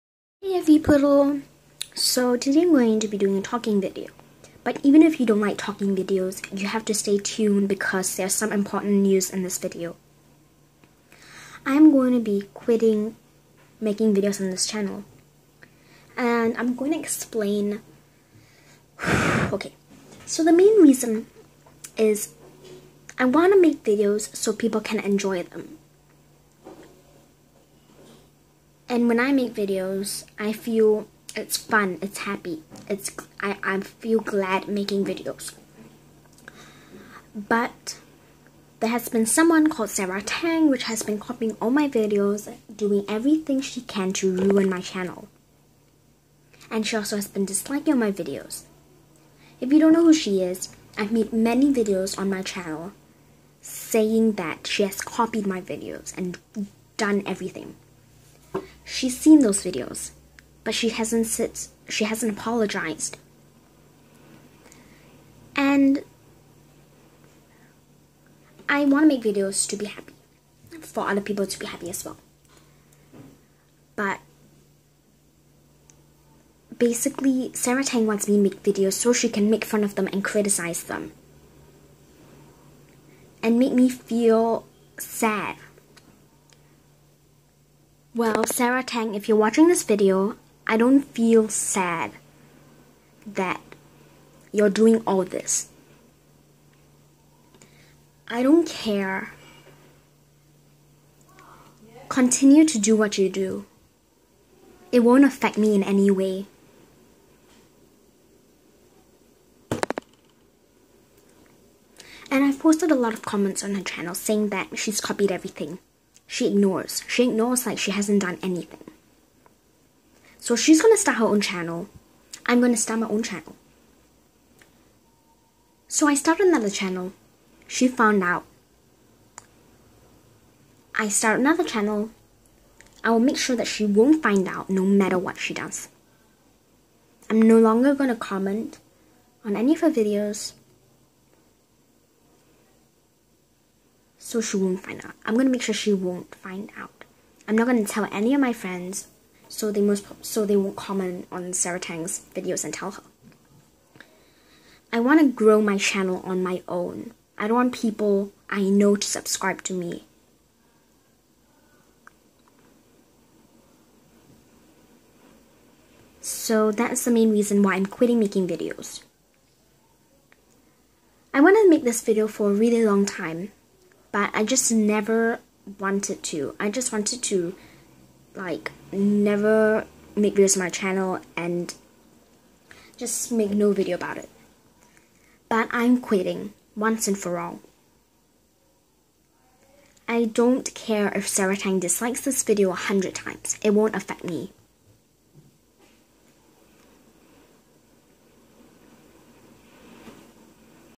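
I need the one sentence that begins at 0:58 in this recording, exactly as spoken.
She's seen those videos, but she hasn't sit, she hasn't apologized.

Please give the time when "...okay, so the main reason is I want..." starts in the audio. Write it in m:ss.
0:19.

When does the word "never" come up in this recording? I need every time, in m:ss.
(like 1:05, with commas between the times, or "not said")
2:54, 2:58.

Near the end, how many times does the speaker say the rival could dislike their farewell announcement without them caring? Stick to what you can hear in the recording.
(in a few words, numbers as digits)
100.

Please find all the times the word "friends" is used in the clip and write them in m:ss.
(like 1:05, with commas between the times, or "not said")
2:28.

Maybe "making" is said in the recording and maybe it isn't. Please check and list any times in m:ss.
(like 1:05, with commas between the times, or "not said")
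0:13, 0:34, 2:48.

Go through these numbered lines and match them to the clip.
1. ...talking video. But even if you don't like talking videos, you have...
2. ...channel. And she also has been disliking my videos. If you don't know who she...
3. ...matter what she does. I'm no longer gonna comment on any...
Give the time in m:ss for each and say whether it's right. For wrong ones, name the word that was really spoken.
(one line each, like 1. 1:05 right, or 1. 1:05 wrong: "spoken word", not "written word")
1. 0:03 right
2. 0:44 right
3. 2:14 right.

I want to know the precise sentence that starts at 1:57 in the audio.
She ignores like she hasn't done anything.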